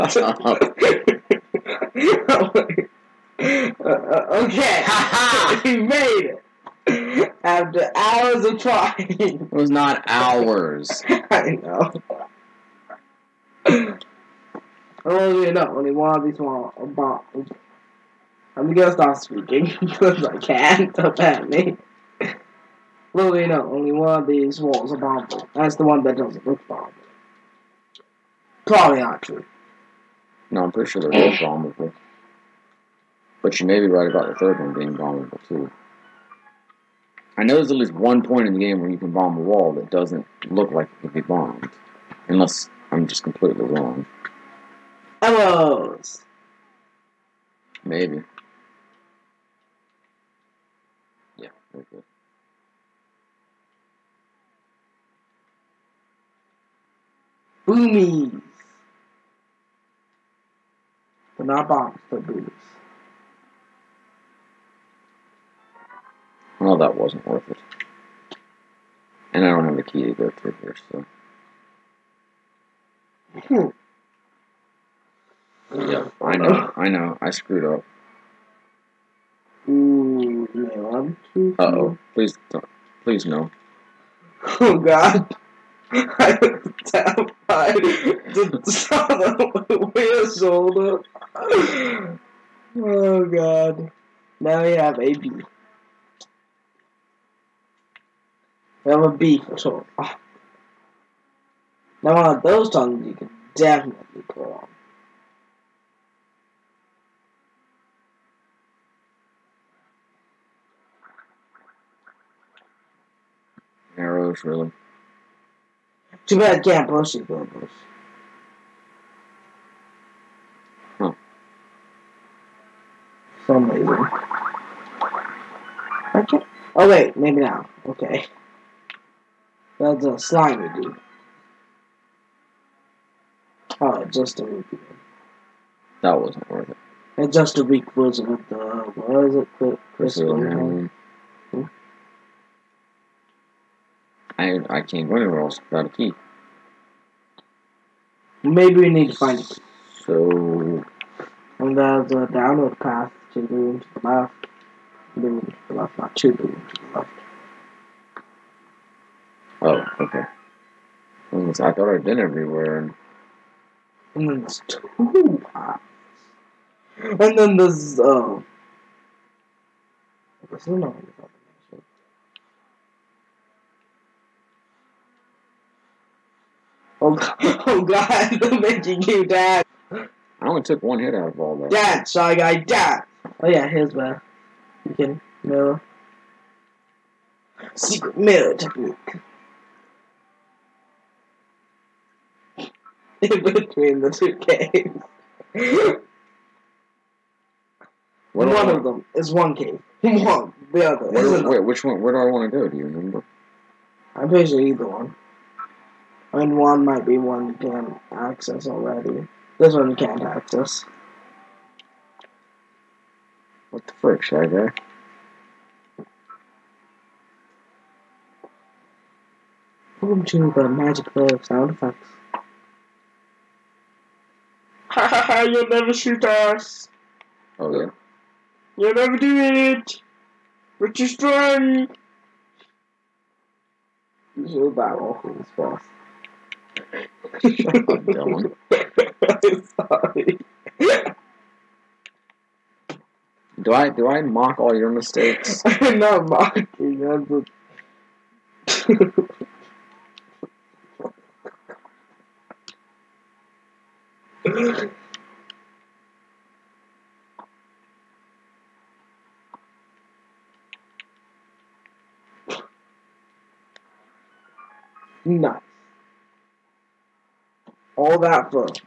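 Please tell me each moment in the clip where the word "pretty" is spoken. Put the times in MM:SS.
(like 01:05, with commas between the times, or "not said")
00:30, 03:24.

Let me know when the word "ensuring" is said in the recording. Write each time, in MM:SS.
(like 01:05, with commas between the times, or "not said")
not said.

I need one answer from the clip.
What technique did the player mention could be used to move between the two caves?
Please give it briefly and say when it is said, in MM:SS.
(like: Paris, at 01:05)
Secret mirror technique, at 03:07.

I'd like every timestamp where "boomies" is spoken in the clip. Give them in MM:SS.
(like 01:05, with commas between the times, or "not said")
00:57, 01:02.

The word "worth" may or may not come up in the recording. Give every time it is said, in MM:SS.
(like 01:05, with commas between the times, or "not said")
01:07, 02:16.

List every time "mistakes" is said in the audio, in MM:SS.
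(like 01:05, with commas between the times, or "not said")
04:04.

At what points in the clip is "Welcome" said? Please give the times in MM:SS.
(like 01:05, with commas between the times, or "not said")
03:40.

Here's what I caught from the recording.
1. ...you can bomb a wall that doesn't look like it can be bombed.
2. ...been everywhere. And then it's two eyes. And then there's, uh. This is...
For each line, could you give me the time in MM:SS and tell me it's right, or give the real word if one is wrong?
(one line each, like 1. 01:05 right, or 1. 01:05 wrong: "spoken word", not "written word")
1. 00:38 right
2. 02:42 right.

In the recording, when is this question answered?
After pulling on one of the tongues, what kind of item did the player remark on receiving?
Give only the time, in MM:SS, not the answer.
01:53.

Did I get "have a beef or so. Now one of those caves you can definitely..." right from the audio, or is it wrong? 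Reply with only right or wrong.
wrong.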